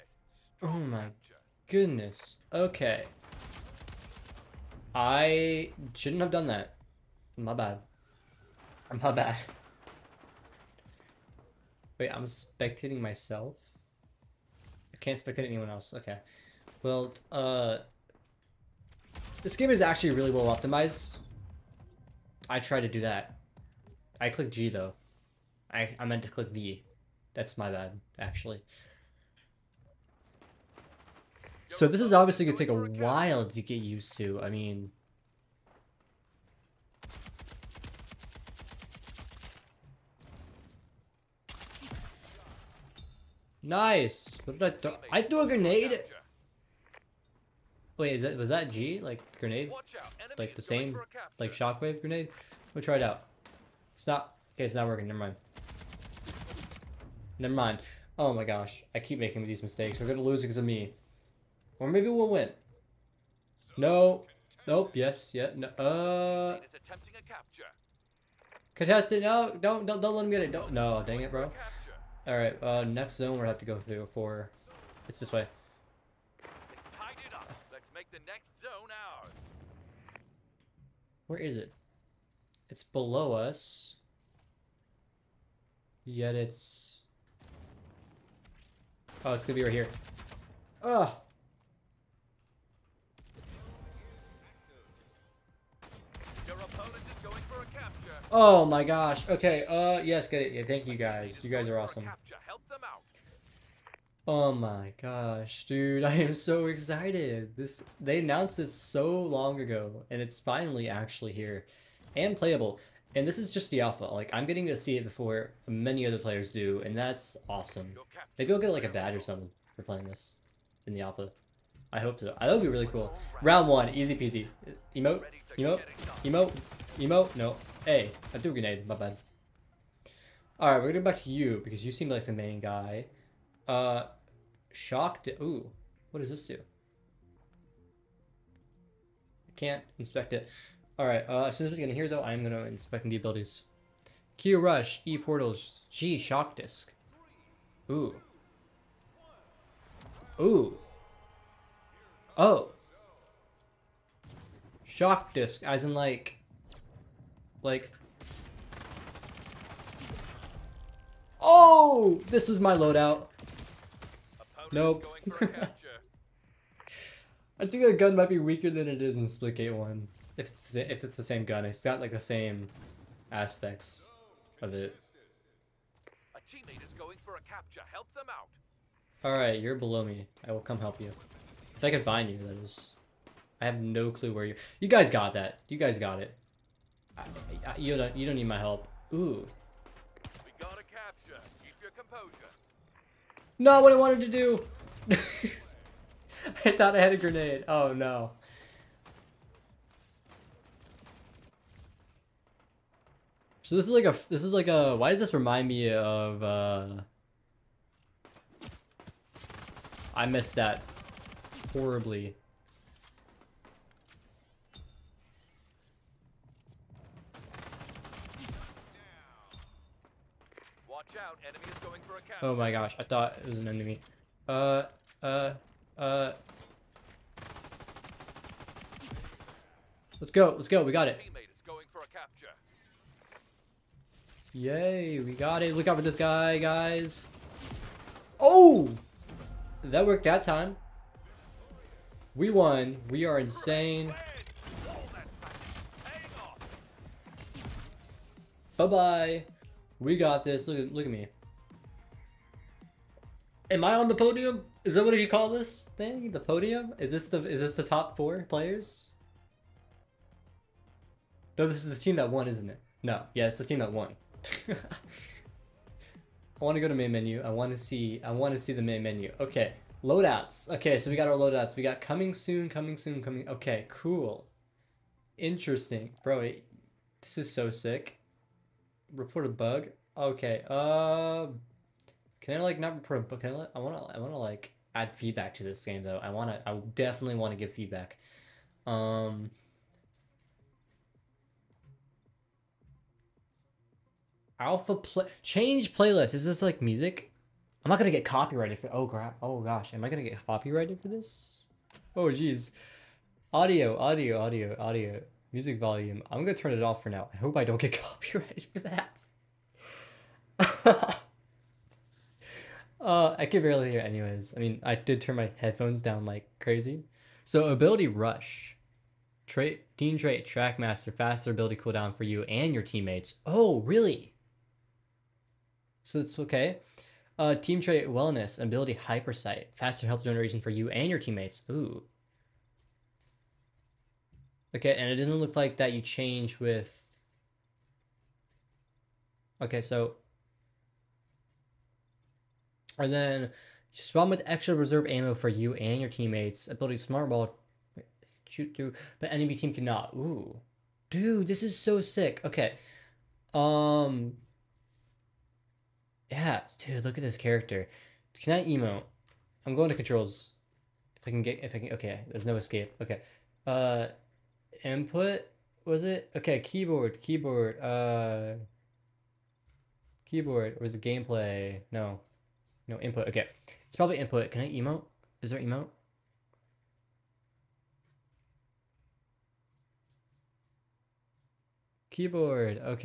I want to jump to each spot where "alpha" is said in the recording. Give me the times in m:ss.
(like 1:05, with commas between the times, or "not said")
1:53, 2:01, 4:54.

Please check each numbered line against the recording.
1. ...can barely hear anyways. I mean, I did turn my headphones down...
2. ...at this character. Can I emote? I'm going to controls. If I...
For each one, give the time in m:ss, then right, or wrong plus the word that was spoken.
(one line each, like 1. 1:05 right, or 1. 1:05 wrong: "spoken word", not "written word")
1. 5:13 right
2. 5:57 right.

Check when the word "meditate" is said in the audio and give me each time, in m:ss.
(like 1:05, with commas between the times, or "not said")
not said.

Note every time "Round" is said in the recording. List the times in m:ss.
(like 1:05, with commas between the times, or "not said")
2:03.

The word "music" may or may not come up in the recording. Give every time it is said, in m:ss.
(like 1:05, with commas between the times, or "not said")
4:56, 5:05.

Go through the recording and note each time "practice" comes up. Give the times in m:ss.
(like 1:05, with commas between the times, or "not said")
not said.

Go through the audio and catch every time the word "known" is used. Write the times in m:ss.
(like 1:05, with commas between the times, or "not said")
not said.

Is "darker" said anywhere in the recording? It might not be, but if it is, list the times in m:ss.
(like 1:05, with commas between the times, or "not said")
not said.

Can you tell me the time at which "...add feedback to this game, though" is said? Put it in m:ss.
4:44.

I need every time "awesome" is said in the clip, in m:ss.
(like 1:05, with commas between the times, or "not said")
1:41, 1:57.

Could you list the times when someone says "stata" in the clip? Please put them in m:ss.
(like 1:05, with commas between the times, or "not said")
not said.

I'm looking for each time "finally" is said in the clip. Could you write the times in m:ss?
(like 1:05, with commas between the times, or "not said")
1:50.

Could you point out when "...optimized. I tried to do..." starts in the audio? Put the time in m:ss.
0:20.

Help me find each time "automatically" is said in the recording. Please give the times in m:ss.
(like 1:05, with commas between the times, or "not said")
not said.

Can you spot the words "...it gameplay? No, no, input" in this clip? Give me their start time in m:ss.
6:10.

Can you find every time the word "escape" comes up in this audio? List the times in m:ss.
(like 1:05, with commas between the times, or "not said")
6:02.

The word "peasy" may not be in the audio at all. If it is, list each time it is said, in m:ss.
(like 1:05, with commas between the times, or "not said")
2:04.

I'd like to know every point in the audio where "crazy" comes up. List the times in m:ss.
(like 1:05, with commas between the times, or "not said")
5:16.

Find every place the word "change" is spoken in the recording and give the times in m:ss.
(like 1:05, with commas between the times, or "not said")
4:55, 5:36.